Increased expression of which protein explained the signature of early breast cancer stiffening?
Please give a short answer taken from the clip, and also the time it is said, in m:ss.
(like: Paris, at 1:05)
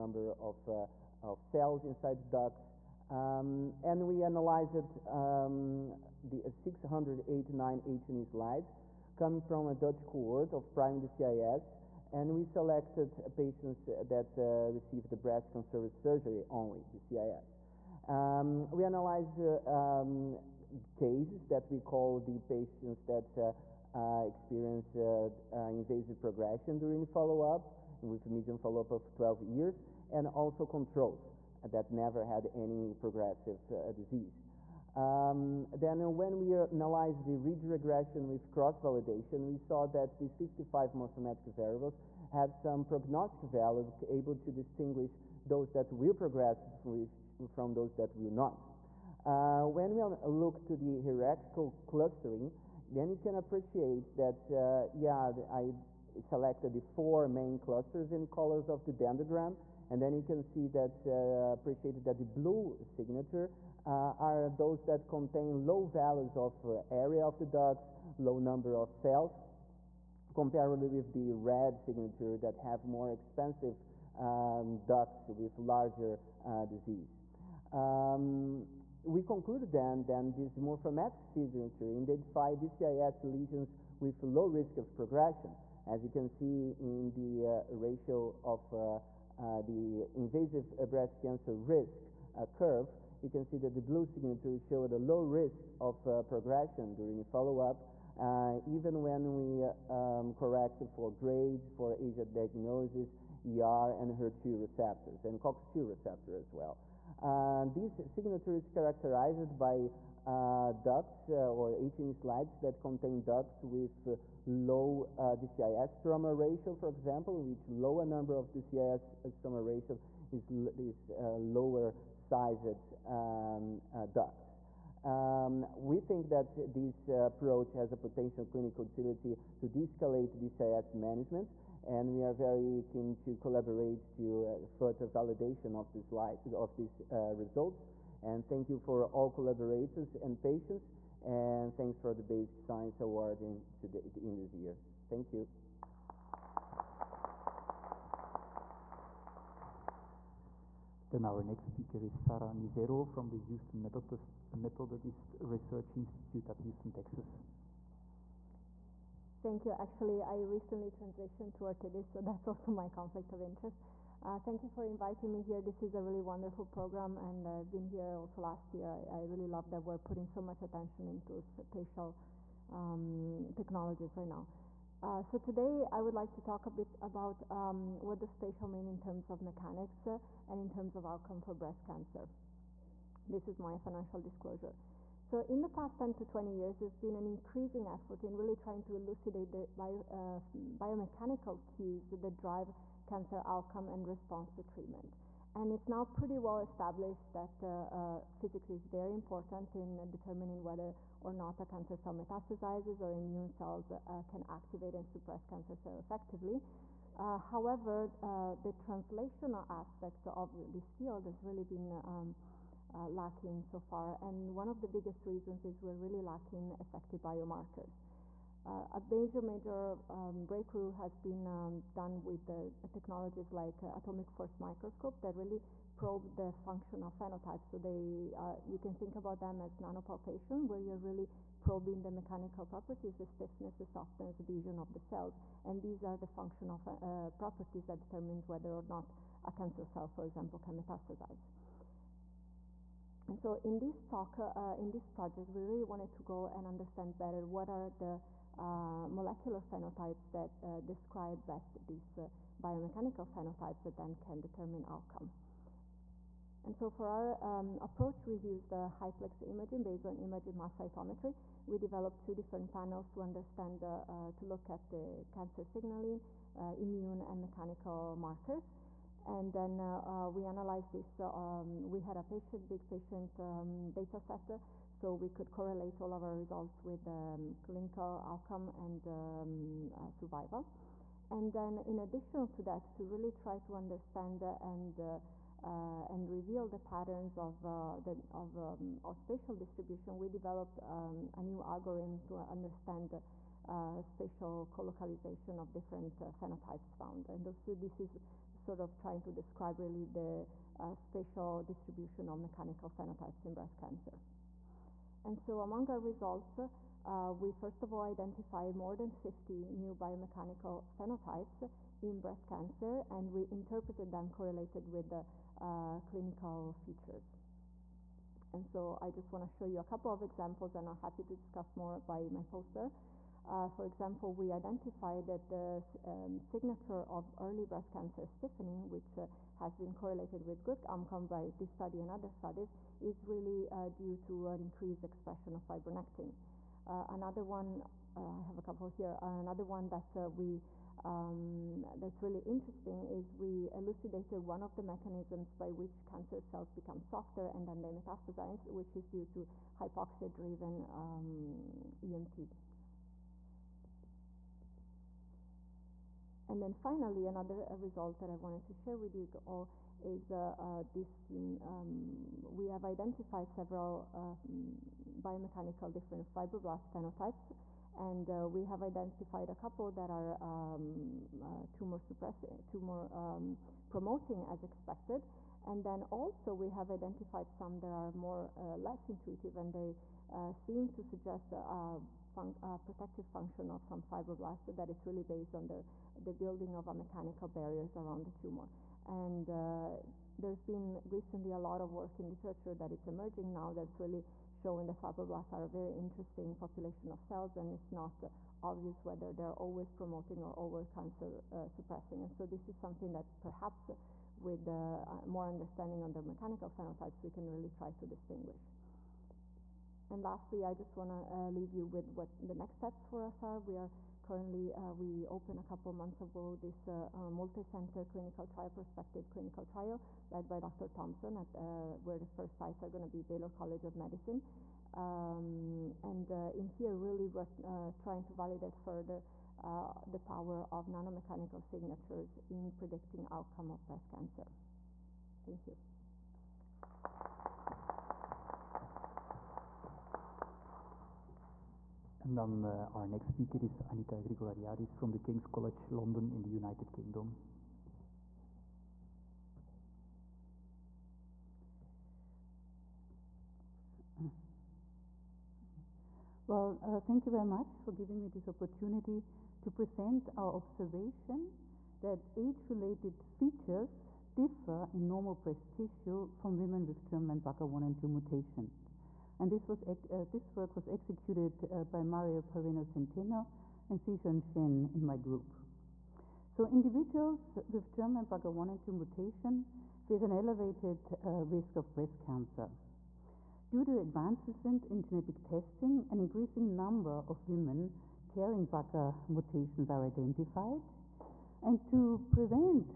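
fibronectin, at 5:35.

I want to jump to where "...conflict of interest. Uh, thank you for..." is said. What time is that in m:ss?
2:42.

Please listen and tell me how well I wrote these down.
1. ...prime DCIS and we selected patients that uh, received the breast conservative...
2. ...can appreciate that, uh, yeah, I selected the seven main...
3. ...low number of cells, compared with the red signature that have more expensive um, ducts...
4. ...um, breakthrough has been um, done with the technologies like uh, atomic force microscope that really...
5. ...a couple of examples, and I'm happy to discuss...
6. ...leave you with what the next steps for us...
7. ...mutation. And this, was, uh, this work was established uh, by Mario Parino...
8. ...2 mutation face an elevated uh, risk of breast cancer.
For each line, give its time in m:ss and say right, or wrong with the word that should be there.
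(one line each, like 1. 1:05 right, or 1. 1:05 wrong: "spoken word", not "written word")
1. 0:10 right
2. 0:53 wrong: "four", not "seven"
3. 1:08 right
4. 3:40 right
5. 5:19 right
6. 6:51 right
7. 7:48 wrong: "executed", not "established"
8. 7:58 right.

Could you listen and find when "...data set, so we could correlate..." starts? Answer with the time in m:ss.
4:33.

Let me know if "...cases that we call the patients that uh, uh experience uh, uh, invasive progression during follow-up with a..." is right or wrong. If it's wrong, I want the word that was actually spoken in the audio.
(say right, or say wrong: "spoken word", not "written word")
right.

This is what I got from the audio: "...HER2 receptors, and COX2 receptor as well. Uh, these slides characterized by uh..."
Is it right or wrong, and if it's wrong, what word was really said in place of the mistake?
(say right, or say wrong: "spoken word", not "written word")
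wrong: "signatures", not "slides".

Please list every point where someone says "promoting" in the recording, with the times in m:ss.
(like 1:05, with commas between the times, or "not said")
6:13, 6:39.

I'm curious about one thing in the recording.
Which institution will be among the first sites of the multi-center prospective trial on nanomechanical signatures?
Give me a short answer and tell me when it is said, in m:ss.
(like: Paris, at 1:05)
Baylor College of Medicine, at 7:03.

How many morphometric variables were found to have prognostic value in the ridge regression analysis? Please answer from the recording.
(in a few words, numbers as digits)
55.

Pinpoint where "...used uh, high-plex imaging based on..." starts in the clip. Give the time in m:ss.
4:18.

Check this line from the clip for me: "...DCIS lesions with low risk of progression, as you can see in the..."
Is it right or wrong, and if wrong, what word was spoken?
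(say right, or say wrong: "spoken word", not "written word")
right.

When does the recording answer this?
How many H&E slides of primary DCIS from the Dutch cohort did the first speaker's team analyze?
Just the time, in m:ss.
0:06.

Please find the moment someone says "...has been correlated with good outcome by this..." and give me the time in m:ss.
5:29.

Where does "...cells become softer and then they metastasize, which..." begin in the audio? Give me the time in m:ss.
5:46.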